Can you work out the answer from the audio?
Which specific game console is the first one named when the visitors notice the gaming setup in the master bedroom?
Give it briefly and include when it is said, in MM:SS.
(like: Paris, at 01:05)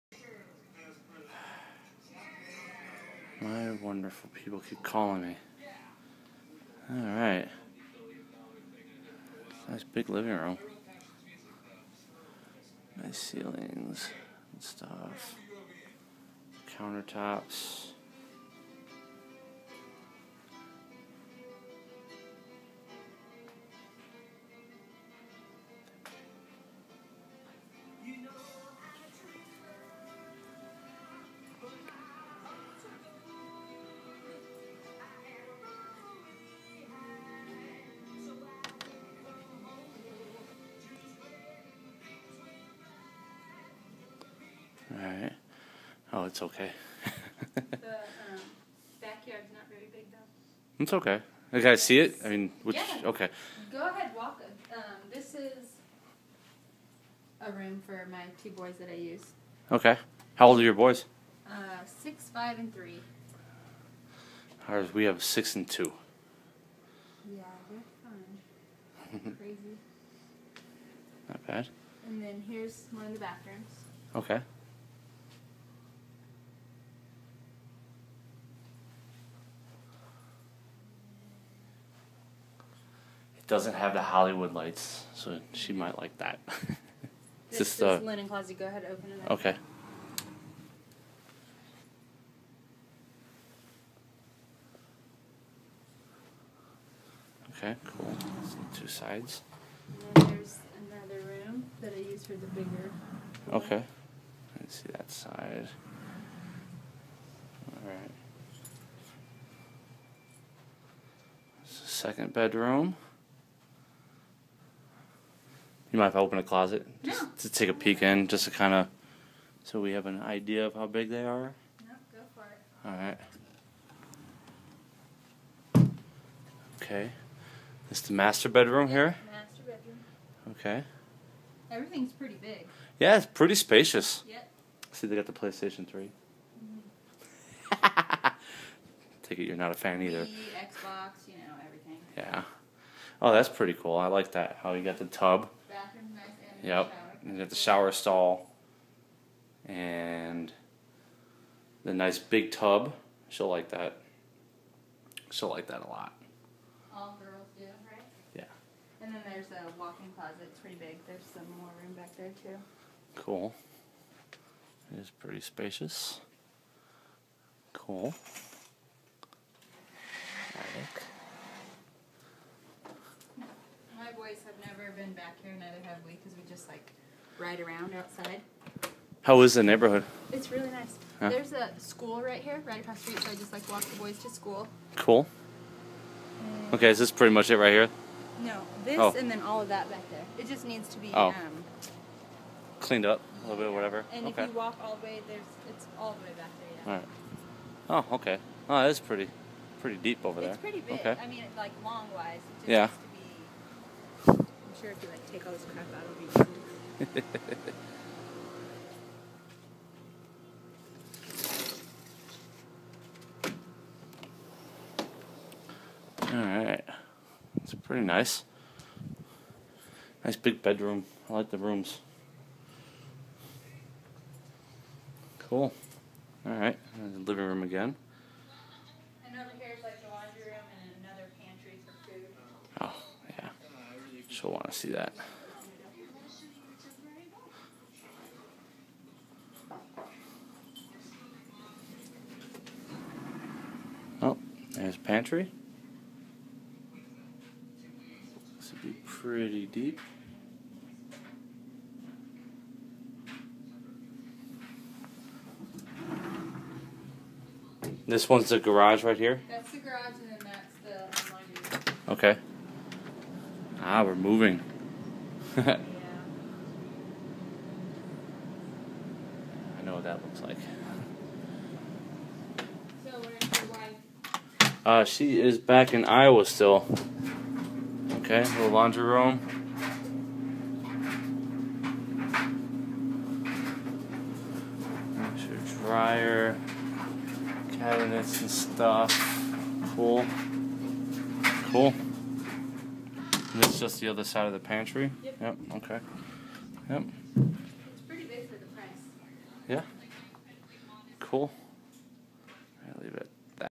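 PlayStation 3, at 02:15.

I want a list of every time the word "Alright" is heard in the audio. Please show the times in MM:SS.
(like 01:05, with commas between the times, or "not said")
00:06, 01:47, 03:36, 03:46.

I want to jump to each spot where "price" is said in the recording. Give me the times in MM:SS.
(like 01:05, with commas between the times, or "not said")
04:58.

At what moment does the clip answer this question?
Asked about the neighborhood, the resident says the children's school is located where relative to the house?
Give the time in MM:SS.
03:02.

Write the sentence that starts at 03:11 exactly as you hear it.
um, cleaned up a little bit or whatever.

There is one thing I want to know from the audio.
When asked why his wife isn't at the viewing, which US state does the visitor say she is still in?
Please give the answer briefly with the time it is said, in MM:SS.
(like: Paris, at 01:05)
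Iowa, at 04:36.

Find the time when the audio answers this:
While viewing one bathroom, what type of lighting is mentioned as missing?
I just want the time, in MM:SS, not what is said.
01:24.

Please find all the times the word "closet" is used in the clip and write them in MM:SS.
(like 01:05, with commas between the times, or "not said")
01:28, 01:56, 02:40.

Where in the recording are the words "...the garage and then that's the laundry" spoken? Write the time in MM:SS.
04:19.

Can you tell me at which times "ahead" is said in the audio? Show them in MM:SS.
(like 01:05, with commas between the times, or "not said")
00:53, 01:28.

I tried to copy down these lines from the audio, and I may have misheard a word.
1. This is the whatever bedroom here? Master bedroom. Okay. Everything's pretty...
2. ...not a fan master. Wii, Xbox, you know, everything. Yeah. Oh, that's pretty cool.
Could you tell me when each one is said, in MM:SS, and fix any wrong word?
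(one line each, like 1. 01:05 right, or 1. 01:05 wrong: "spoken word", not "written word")
1. 02:07 wrong: "master", not "whatever"
2. 02:19 wrong: "either", not "master".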